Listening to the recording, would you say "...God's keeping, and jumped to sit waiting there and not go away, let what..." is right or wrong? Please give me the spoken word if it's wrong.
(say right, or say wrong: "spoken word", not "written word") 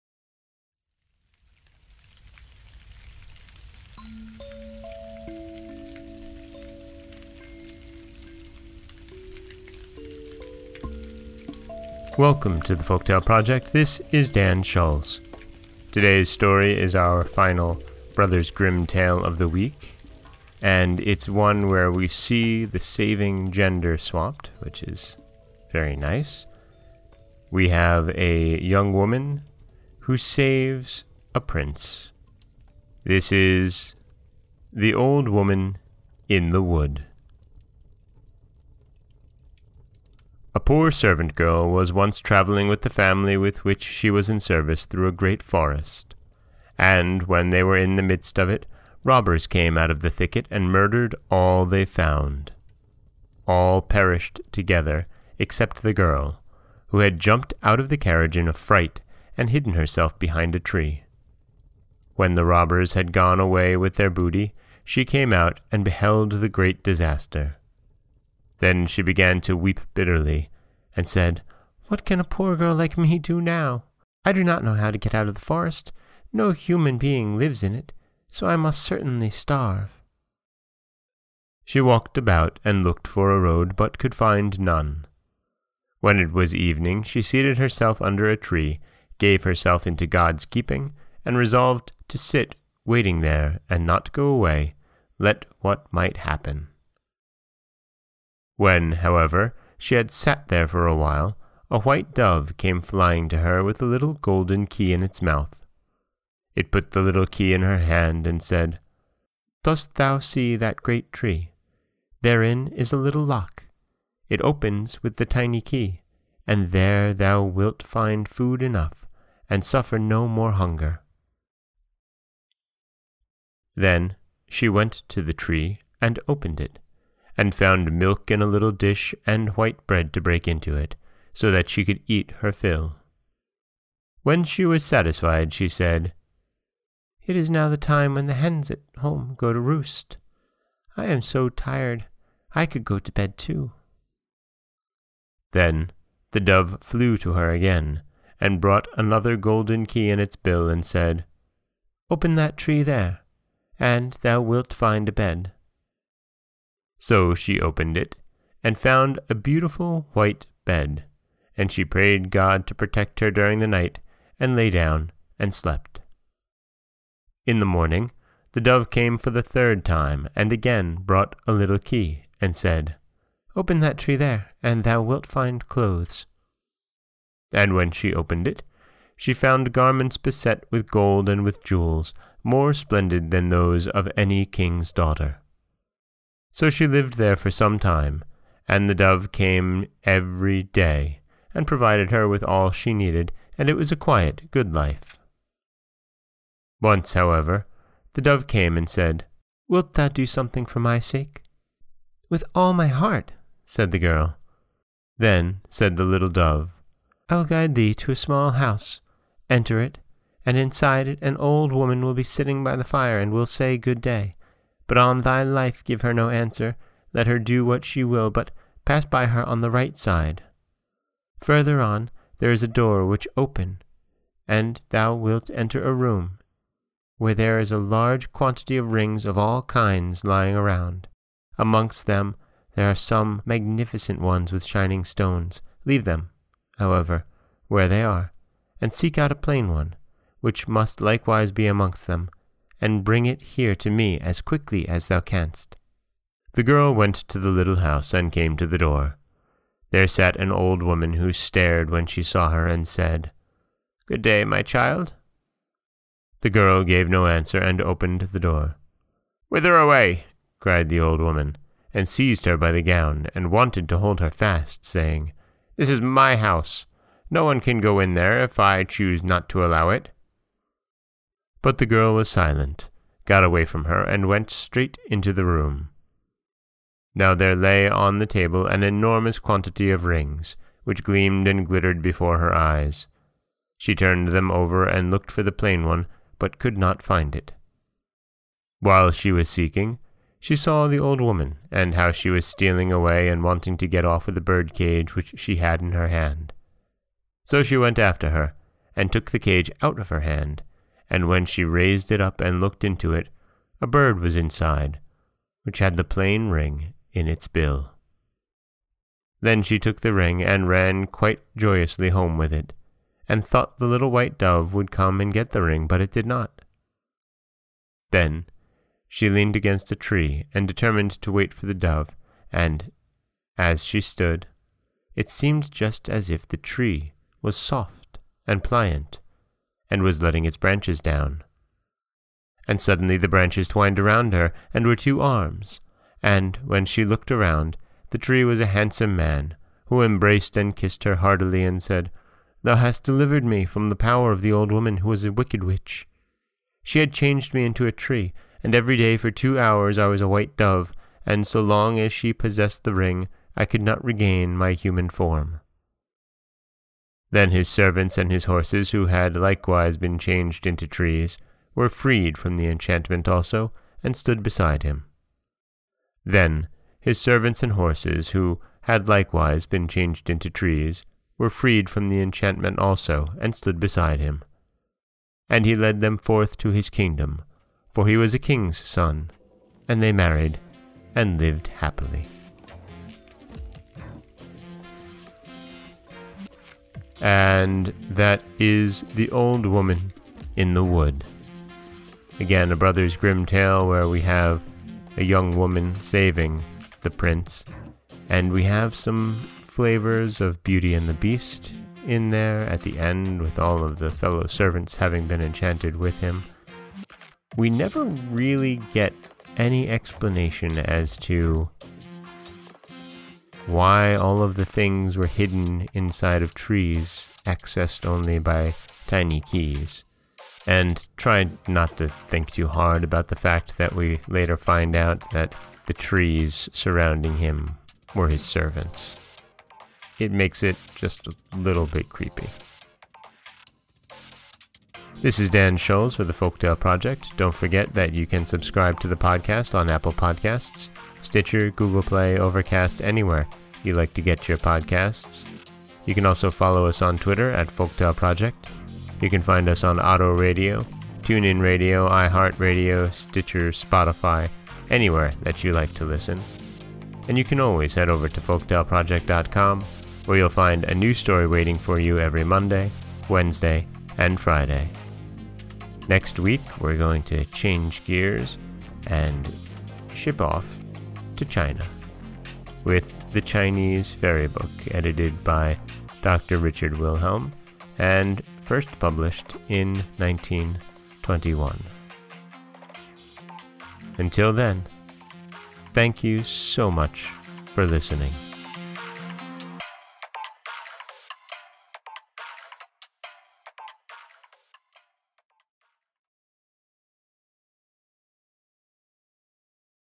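wrong: "resolved", not "jumped".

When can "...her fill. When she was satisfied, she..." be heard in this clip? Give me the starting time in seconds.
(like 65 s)
132 s.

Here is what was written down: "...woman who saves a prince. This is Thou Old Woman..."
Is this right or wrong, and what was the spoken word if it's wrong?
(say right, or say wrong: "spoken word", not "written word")
wrong: "The", not "Thou".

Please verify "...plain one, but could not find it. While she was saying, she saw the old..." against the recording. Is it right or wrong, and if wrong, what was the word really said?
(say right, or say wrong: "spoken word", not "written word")
wrong: "seeking", not "saying".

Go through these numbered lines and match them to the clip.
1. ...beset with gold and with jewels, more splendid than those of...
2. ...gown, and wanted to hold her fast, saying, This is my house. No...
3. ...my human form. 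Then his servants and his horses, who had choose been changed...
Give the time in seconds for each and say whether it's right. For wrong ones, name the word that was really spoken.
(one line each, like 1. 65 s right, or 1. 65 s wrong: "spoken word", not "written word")
1. 180 s right
2. 262 s right
3. 354 s wrong: "likewise", not "choose".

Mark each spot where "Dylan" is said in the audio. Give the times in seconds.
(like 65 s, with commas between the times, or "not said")
not said.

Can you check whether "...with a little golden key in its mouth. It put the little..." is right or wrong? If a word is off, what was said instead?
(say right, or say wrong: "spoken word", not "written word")
right.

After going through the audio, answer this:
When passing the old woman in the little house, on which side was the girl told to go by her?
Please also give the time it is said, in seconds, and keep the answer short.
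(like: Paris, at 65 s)
right side, at 219 s.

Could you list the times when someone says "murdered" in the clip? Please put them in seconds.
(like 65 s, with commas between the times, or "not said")
50 s.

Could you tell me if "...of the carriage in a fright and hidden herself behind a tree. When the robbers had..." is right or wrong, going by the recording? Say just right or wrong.
right.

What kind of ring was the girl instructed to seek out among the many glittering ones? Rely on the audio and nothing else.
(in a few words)
a plain one.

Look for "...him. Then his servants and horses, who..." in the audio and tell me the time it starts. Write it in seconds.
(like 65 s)
364 s.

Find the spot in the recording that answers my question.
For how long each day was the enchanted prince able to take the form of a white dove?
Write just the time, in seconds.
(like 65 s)
349 s.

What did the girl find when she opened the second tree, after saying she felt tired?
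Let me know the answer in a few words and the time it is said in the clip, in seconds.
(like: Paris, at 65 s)
a beautiful white bed, at 159 s.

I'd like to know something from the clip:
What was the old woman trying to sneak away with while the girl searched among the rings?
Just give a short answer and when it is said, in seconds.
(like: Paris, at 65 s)
the bird cage, at 294 s.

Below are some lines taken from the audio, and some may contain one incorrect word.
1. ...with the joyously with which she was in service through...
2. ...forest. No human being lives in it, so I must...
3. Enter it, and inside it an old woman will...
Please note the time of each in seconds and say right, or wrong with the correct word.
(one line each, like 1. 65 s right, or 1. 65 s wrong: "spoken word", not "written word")
1. 42 s wrong: "family", not "joyously"
2. 75 s right
3. 209 s right.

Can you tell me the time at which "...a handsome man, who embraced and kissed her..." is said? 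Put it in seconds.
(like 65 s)
338 s.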